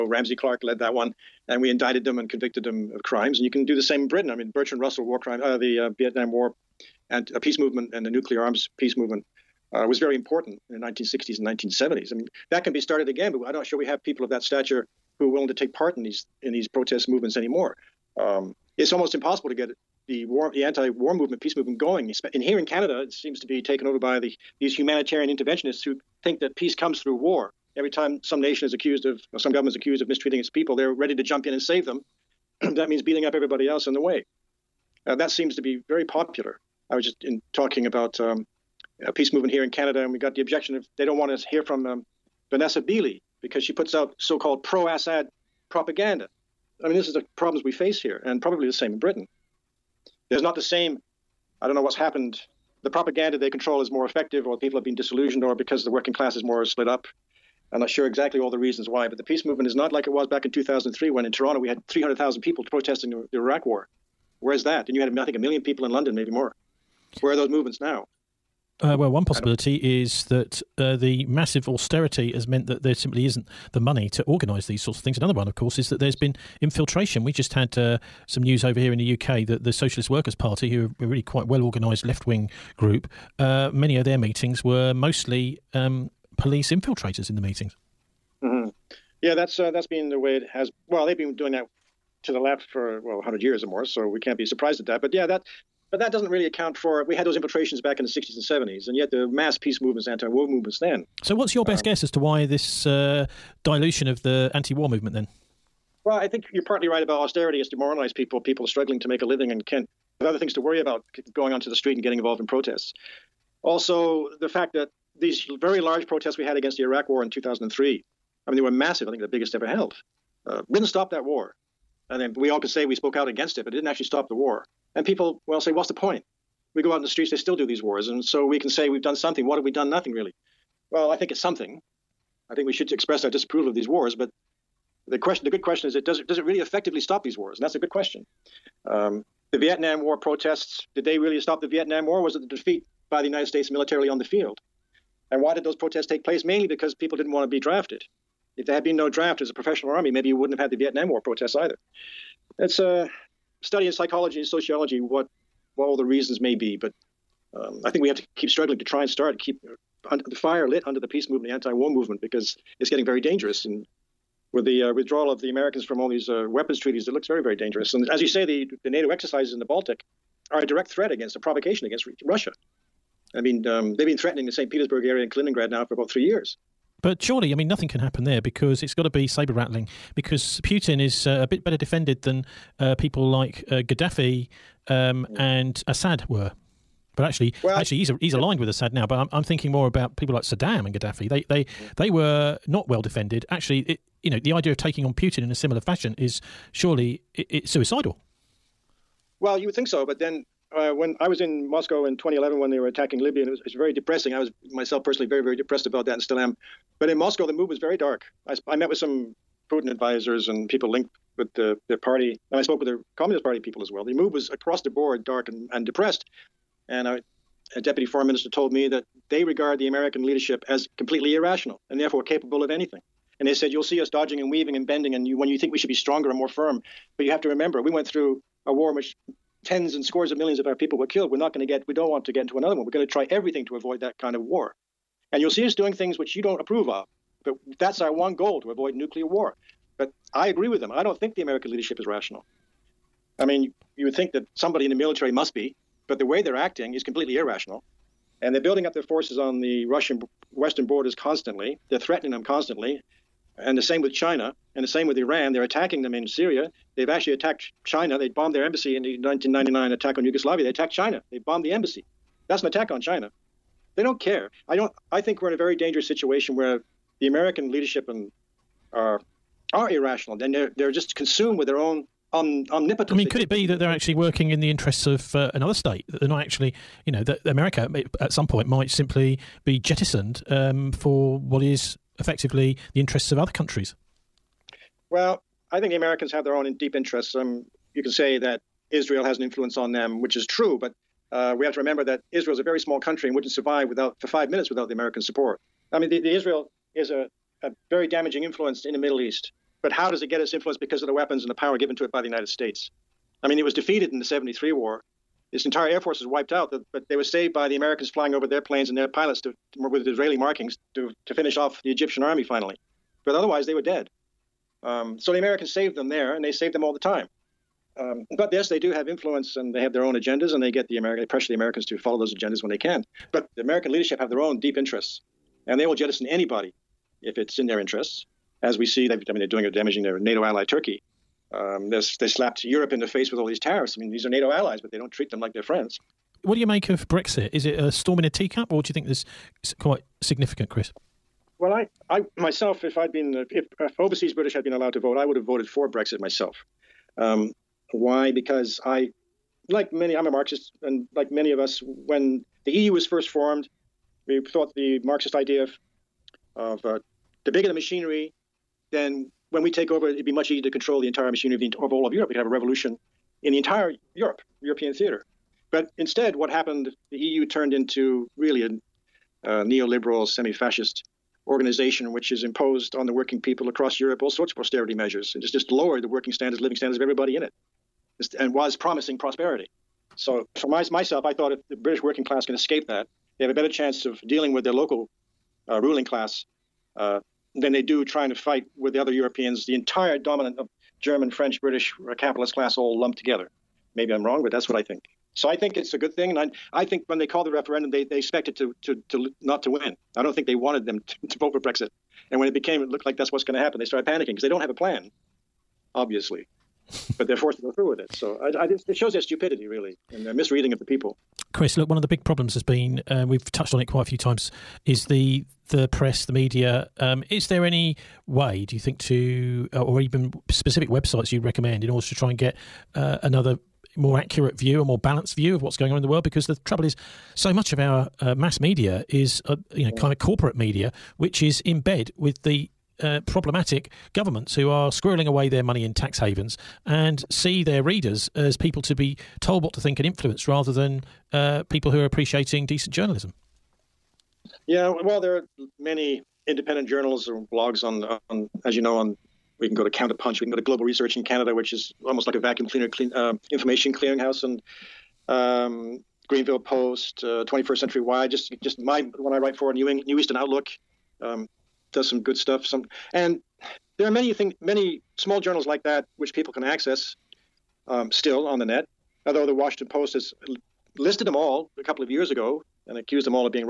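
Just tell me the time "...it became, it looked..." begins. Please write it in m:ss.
6:42.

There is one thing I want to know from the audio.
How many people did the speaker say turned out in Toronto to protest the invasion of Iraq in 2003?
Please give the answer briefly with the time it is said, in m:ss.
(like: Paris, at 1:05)
300,000, at 1:01.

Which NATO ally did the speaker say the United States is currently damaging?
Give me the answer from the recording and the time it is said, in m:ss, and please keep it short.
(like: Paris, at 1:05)
Turkey, at 5:30.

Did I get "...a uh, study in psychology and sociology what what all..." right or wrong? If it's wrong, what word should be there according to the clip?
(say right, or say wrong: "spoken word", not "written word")
right.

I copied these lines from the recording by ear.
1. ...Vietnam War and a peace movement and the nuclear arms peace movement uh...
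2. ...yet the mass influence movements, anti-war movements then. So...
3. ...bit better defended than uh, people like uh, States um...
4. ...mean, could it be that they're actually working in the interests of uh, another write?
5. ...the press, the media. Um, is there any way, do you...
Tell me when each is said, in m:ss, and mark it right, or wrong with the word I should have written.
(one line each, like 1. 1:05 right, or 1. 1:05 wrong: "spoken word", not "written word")
1. 0:05 right
2. 1:38 wrong: "peace", not "influence"
3. 3:01 wrong: "Gaddafi", not "States"
4. 4:33 wrong: "state", not "write"
5. 6:55 right.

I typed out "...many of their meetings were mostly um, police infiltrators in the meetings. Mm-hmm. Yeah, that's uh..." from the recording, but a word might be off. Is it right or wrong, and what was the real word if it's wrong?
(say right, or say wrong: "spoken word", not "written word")
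right.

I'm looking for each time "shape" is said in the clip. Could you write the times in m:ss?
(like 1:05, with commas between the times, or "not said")
not said.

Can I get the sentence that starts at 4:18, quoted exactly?
They bombed their embassy in the 1999 attack on Yugoslavia.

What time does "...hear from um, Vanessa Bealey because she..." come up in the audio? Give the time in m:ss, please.
0:41.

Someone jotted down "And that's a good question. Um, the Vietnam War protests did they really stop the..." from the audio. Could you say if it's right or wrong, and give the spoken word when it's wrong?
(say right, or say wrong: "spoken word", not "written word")
right.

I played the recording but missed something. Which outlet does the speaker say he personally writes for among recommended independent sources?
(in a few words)
New Eastern Outlook.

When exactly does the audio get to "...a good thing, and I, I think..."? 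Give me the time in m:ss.
6:35.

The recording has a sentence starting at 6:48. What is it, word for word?
So I, I, it shows their stupidity, really, and their misreading of the people.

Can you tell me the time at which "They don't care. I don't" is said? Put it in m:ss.
4:23.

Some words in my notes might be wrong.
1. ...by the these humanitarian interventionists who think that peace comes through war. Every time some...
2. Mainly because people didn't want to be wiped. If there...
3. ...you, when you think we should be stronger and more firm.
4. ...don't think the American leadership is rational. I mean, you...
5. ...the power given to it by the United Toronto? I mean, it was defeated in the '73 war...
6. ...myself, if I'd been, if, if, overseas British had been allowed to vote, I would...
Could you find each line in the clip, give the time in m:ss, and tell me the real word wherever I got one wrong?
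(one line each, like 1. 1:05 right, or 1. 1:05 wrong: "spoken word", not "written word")
1. 0:23 right
2. 2:26 wrong: "drafted", not "wiped"
3. 3:45 right
4. 4:01 right
5. 5:01 wrong: "States", not "Toronto"
6. 5:42 right.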